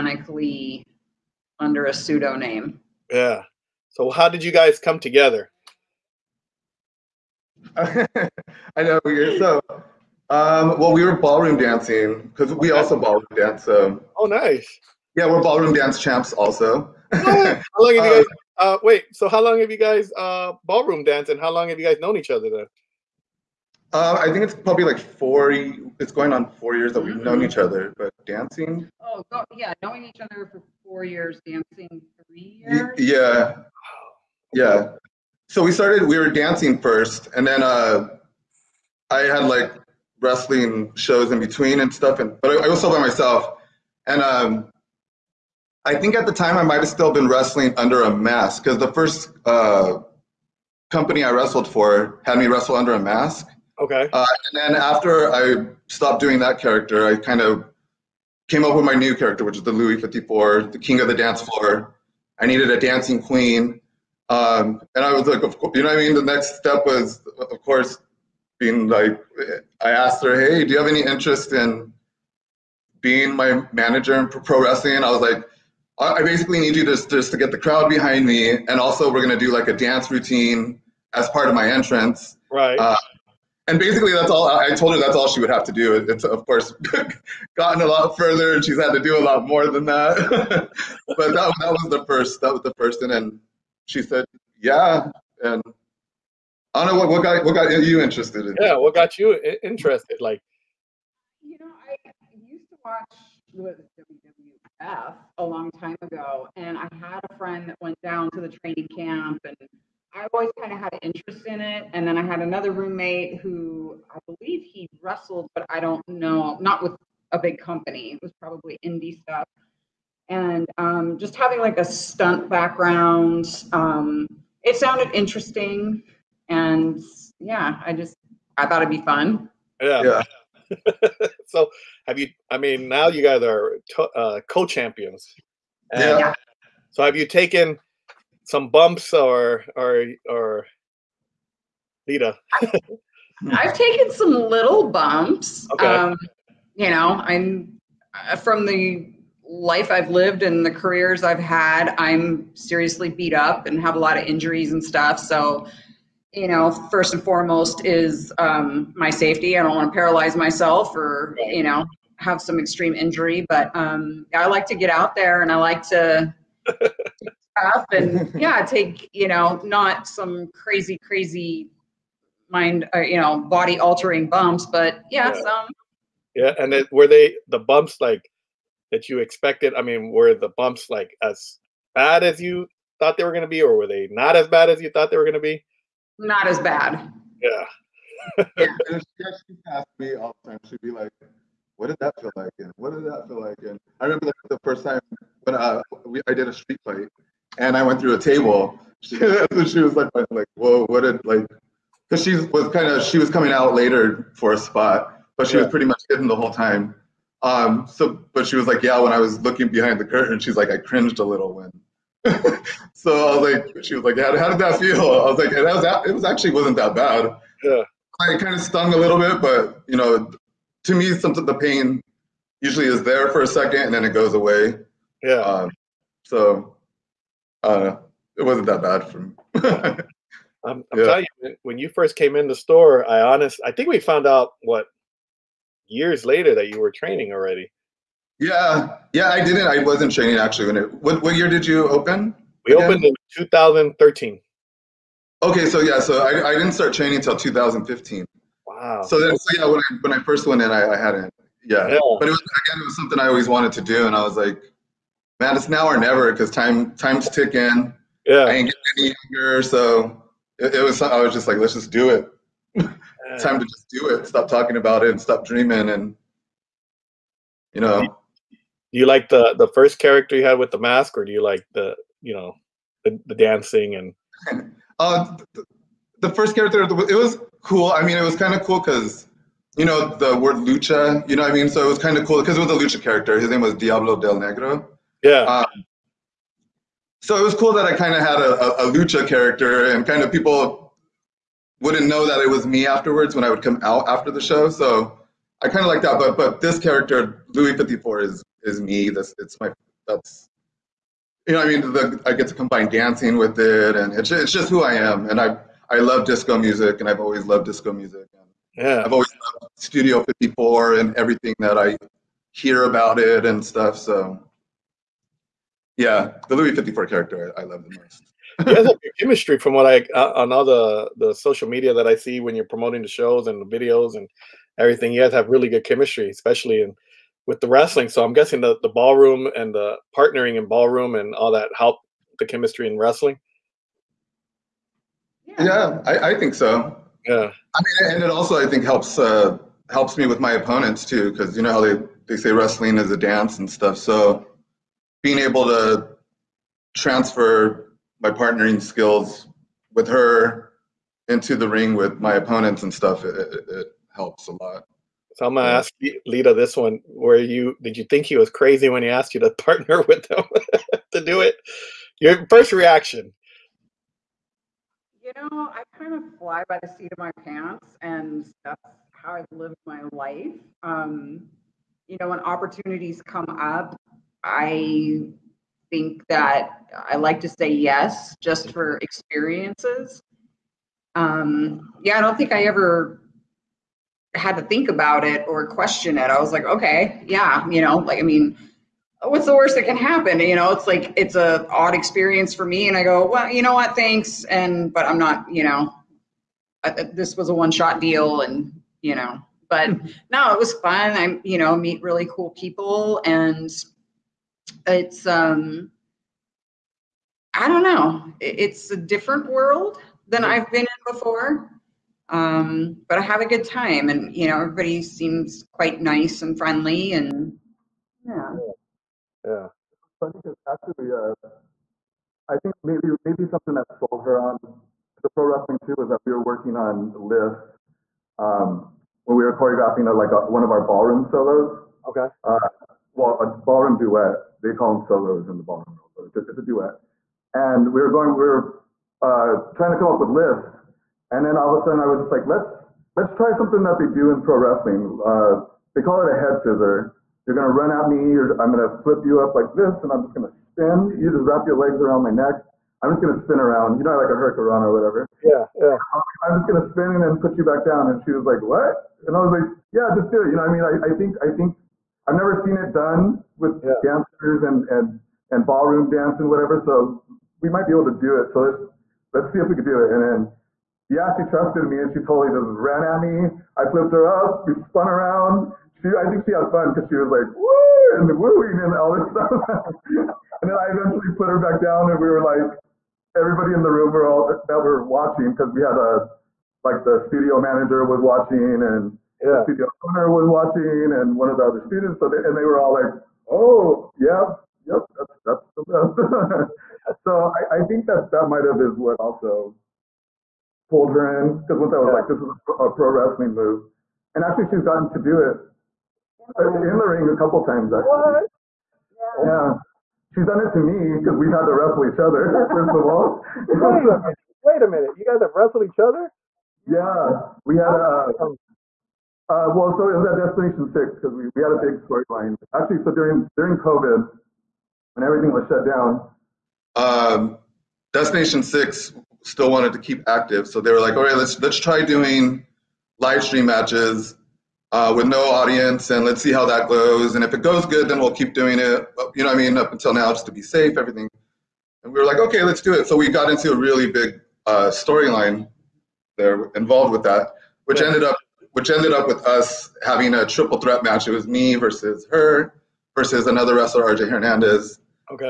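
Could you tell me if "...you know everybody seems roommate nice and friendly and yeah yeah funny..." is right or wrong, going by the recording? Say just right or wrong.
wrong.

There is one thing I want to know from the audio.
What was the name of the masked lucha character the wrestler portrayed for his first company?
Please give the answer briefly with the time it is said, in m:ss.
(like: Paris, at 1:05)
Diablo Del Negro, at 4:43.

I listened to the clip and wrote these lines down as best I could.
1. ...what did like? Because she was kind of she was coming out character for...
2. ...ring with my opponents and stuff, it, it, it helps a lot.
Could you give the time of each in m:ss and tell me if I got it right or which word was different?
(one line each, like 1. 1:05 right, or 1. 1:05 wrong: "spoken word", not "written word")
1. 3:20 wrong: "later", not "character"
2. 5:51 right.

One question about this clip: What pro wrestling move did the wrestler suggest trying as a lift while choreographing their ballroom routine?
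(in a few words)
head scissor.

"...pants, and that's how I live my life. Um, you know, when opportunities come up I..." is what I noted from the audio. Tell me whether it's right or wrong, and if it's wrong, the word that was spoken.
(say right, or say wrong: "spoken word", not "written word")
right.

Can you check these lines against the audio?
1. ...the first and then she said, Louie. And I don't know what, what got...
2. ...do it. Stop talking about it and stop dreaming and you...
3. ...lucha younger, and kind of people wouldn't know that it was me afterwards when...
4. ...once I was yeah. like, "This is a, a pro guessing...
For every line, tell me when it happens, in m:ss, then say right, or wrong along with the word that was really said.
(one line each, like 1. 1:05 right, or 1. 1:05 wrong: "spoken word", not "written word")
1. 1:32 wrong: "Yeah", not "Louie"
2. 4:23 right
3. 4:48 wrong: "character", not "younger"
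4. 8:21 wrong: "wrestling", not "guessing".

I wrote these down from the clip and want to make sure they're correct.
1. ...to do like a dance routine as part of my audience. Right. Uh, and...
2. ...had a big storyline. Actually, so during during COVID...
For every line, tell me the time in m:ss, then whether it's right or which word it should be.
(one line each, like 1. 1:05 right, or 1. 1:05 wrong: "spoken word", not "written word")
1. 1:19 wrong: "entrance", not "audience"
2. 8:41 right.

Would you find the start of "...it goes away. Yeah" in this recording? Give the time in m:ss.
3:44.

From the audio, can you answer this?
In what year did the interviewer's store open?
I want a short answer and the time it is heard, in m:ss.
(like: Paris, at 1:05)
2013, at 4:03.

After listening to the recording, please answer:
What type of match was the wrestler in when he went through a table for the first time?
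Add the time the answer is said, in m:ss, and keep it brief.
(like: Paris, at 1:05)
street fight, at 3:16.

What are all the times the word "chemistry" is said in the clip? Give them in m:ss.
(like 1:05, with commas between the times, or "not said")
5:19, 5:25, 5:32.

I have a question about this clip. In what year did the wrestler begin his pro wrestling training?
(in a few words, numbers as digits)
2015.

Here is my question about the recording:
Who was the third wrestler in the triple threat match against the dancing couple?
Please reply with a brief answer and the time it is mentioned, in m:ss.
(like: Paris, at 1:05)
RJ Hernandez, at 9:14.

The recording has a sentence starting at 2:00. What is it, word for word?
And um, just having like a stunt background, um, it sounded interesting.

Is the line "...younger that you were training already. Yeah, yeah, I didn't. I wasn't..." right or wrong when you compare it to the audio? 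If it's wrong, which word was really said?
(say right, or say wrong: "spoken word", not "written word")
wrong: "later", not "younger".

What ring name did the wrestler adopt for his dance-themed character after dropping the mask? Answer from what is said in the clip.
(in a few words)
Louie 54.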